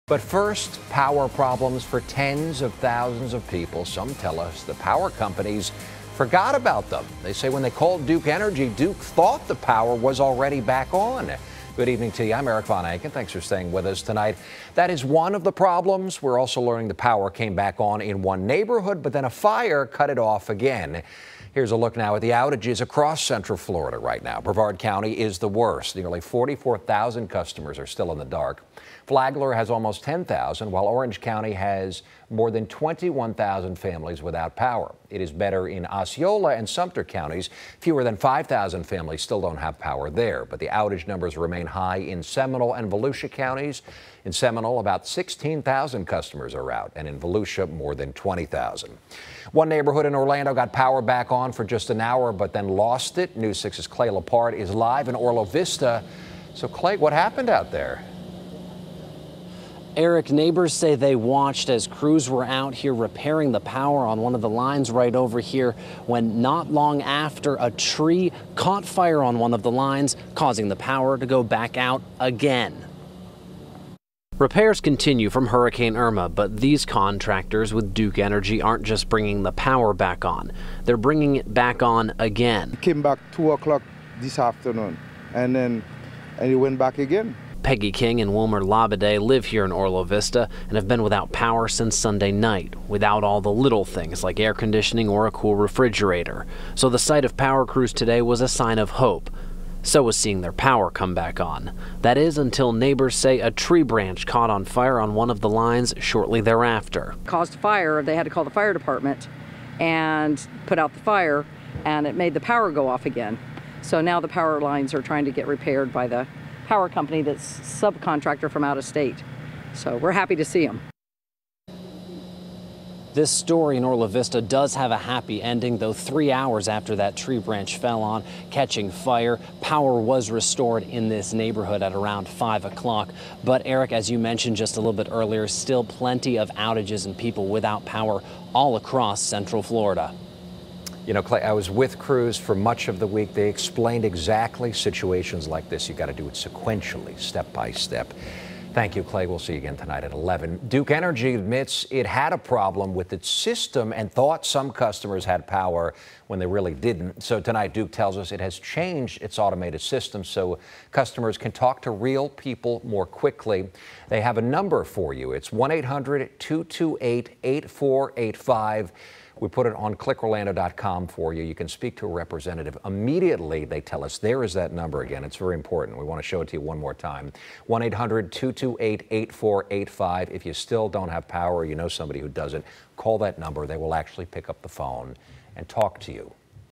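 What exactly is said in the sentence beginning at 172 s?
Immediately, they tell us there is that number again.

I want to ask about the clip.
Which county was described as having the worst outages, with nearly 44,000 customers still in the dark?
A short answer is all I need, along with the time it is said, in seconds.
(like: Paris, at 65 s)
Brevard County, at 24 s.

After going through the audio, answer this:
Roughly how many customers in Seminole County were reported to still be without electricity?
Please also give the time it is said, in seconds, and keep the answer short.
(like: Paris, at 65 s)
16,000, at 45 s.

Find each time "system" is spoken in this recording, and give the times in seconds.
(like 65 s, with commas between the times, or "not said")
153 s, 159 s.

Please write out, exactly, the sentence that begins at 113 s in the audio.
So now the power lines are trying to get repaired by the power company that's subcontractor from out of state.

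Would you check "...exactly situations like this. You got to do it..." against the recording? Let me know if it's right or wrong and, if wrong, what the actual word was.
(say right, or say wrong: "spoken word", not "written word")
right.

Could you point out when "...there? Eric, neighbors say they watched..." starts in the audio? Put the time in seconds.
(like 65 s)
57 s.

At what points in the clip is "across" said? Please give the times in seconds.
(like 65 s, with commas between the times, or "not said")
22 s, 138 s.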